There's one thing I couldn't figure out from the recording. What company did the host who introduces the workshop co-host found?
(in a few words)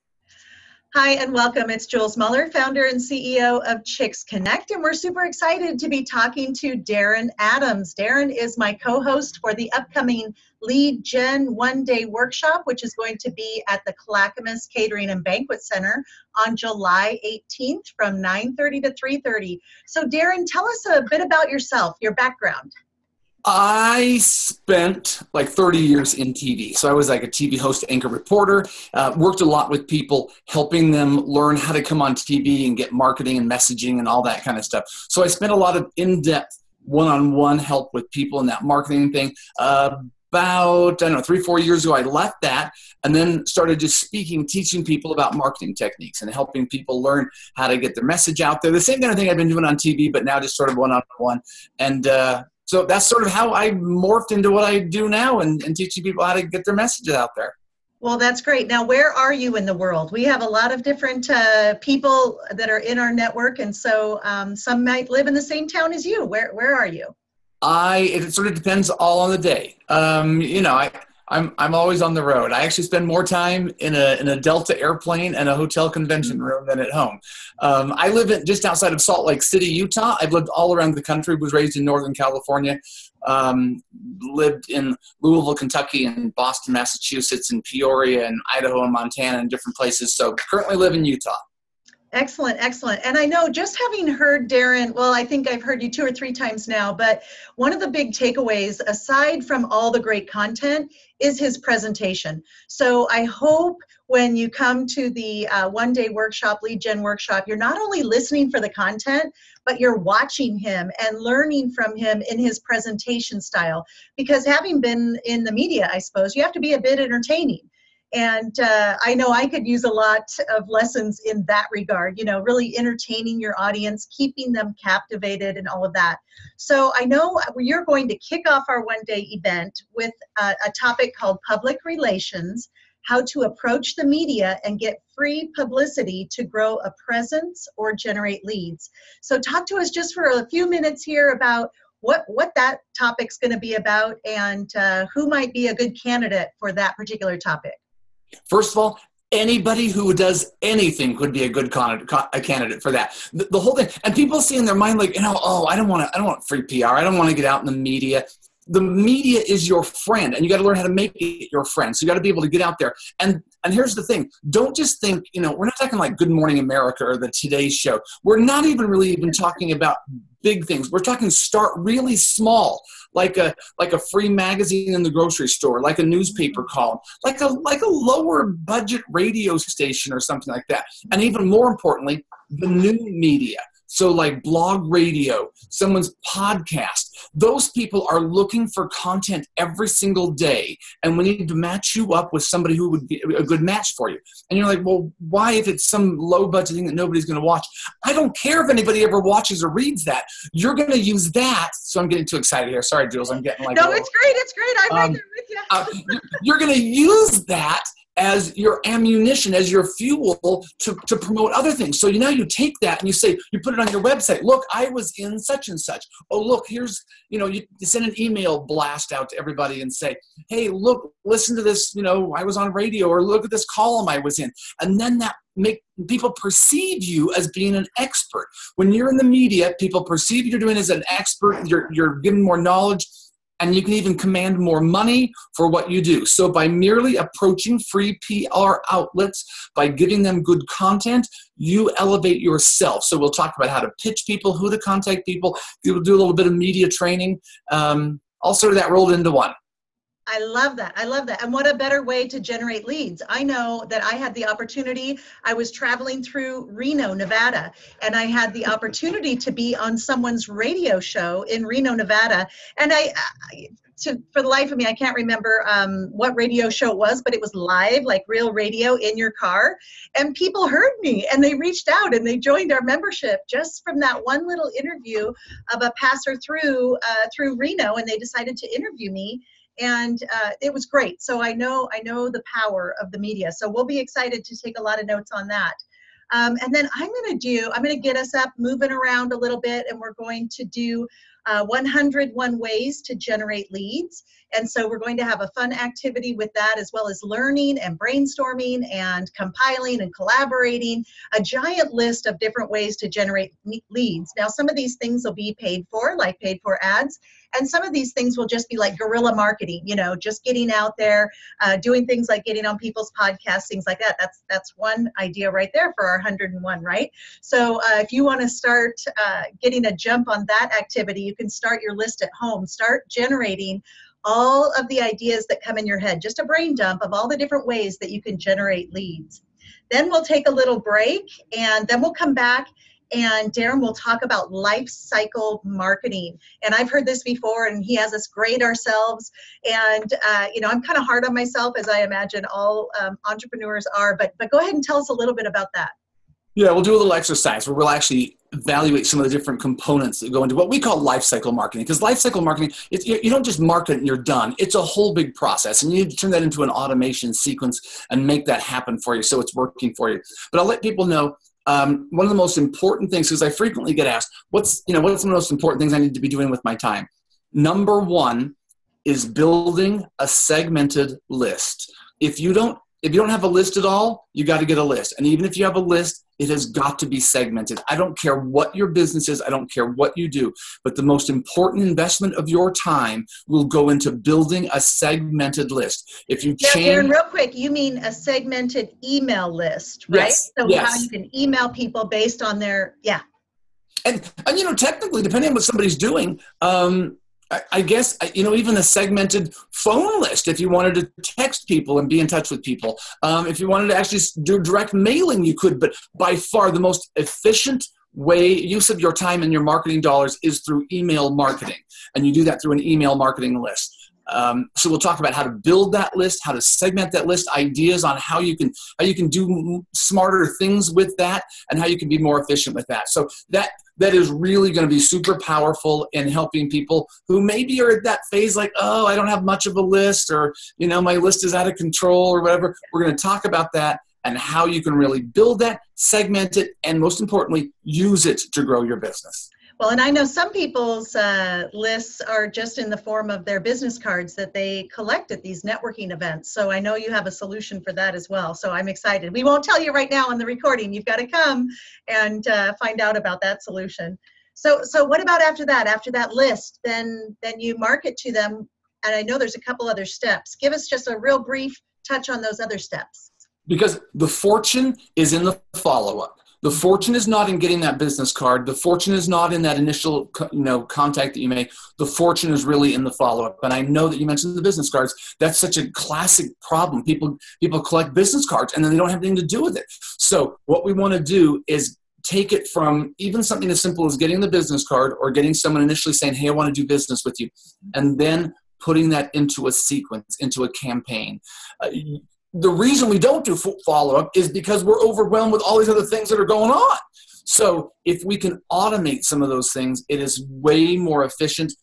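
Chicks Connect.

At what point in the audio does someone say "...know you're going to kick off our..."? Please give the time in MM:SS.
02:07.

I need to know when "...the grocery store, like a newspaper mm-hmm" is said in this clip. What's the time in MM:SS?
02:55.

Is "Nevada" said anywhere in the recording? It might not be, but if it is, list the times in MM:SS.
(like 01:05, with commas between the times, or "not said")
04:17, 04:21.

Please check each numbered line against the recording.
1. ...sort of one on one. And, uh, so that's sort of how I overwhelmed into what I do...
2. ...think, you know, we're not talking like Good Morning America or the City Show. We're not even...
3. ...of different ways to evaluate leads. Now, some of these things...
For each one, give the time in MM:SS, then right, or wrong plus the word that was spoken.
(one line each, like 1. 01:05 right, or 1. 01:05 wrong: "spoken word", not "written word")
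1. 00:50 wrong: "morphed", not "overwhelmed"
2. 02:44 wrong: "Today", not "City"
3. 05:02 wrong: "generate", not "evaluate".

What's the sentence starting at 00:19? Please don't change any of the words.
So Darin, tell us a bit about yourself, your background.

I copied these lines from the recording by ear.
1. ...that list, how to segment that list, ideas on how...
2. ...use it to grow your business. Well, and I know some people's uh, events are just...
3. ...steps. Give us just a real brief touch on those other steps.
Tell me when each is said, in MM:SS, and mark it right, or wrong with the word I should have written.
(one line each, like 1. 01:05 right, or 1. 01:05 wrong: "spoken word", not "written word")
1. 06:55 right
2. 07:17 wrong: "lists", not "events"
3. 07:40 right.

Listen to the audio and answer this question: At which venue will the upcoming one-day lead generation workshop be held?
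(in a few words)
Clackamas Catering and Banquet Center.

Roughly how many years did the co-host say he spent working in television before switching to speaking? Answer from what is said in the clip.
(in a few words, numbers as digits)
30.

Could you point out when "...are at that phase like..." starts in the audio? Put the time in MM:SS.
07:07.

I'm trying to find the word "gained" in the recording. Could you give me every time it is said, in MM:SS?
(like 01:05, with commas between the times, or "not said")
not said.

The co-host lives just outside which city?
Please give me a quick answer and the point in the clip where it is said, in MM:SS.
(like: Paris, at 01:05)
Salt Lake City, at 01:19.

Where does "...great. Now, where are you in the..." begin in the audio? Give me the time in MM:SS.
00:58.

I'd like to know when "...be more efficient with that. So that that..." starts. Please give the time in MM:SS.
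07:02.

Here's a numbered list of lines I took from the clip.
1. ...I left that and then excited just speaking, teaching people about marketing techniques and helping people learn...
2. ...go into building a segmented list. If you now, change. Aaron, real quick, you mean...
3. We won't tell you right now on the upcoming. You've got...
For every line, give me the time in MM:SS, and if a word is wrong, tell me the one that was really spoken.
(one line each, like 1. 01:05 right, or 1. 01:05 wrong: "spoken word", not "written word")
1. 00:41 wrong: "started", not "excited"
2. 06:23 right
3. 07:29 wrong: "recording", not "upcoming".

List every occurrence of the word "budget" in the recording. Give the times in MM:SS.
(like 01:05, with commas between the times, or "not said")
02:58, 03:16.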